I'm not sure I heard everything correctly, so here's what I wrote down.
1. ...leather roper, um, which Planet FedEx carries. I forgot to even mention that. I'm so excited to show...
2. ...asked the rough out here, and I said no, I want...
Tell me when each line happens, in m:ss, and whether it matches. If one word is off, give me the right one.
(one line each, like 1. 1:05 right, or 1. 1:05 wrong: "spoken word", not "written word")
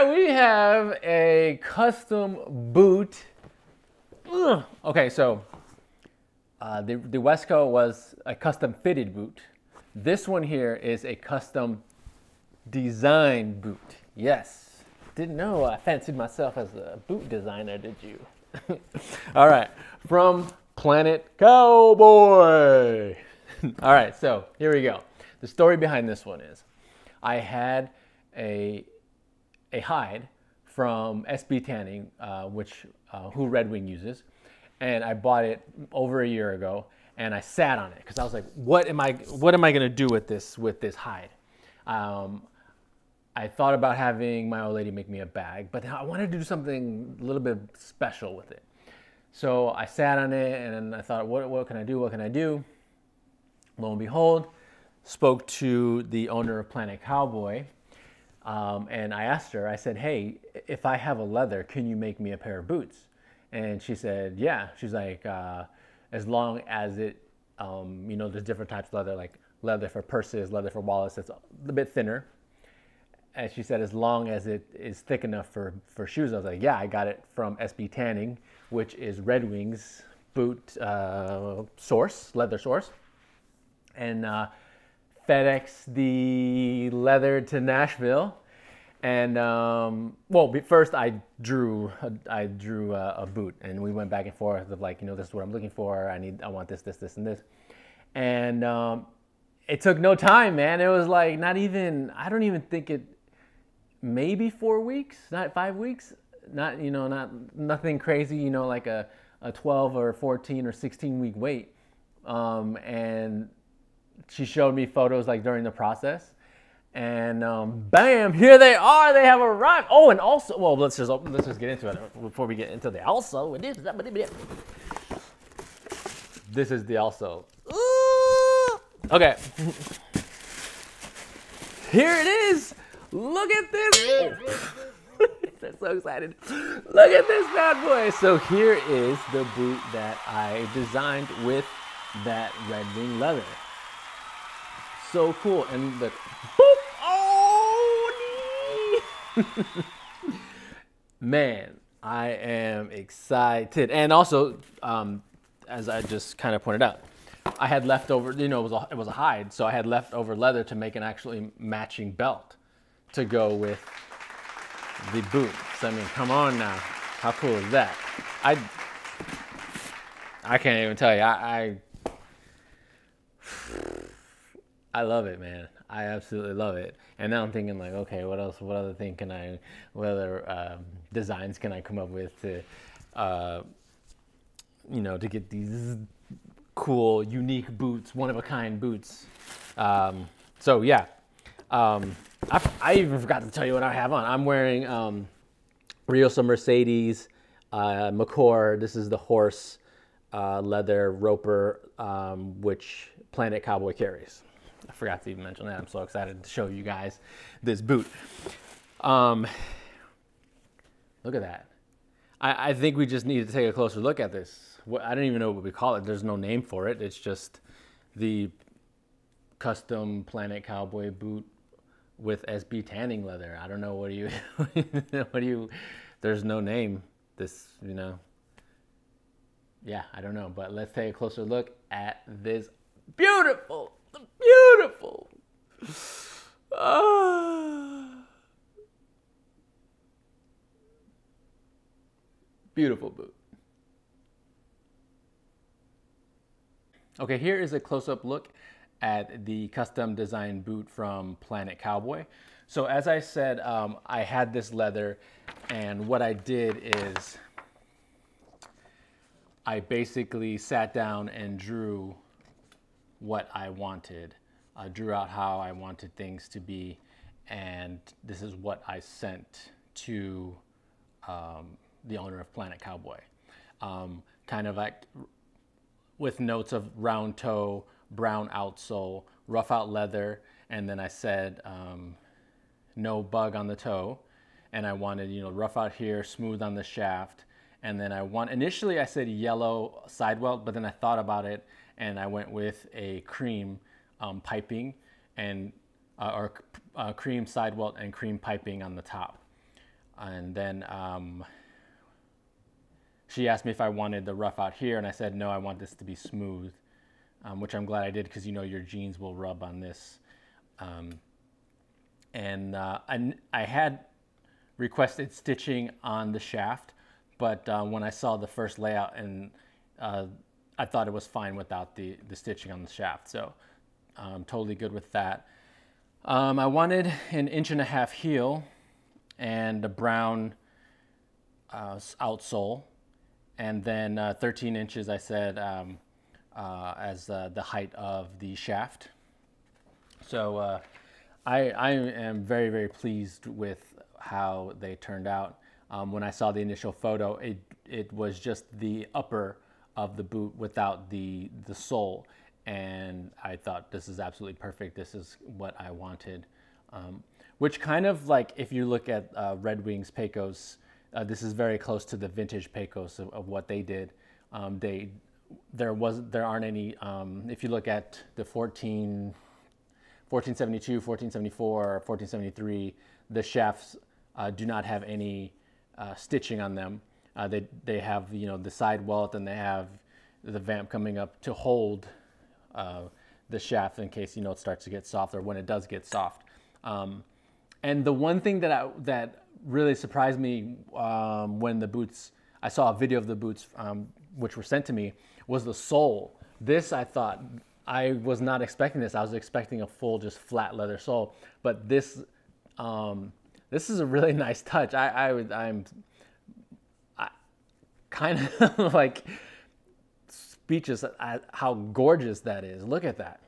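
1. 3:20 wrong: "Cowboy", not "FedEx"
2. 5:03 wrong: "wanted", not "asked".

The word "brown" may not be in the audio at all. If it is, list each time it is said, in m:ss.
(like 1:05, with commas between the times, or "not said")
4:38, 5:29.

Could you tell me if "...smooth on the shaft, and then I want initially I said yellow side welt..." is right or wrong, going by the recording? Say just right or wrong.
right.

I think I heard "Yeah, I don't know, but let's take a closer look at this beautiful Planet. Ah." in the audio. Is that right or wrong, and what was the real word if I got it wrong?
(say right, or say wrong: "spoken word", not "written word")
wrong: "Beautiful", not "Planet".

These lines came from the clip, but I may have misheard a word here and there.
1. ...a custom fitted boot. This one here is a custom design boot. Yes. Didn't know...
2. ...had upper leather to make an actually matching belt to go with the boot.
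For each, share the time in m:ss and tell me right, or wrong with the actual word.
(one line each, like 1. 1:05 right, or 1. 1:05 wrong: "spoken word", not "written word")
1. 0:08 right
2. 2:39 wrong: "leftover", not "upper".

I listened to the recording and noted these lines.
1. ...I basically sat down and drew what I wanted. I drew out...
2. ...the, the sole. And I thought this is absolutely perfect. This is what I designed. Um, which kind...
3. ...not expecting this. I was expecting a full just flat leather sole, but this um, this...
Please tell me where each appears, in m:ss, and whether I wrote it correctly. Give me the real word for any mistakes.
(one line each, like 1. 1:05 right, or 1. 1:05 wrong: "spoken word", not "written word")
1. 4:19 right
2. 5:51 wrong: "wanted", not "designed"
3. 6:38 right.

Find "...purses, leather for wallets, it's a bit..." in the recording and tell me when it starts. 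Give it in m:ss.
1:10.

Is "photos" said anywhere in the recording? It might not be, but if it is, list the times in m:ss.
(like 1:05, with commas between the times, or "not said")
1:54, 5:46.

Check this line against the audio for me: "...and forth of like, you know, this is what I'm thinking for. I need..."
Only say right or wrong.
wrong.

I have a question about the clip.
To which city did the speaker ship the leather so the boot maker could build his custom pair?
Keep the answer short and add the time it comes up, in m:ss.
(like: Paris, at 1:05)
Nashville, at 1:27.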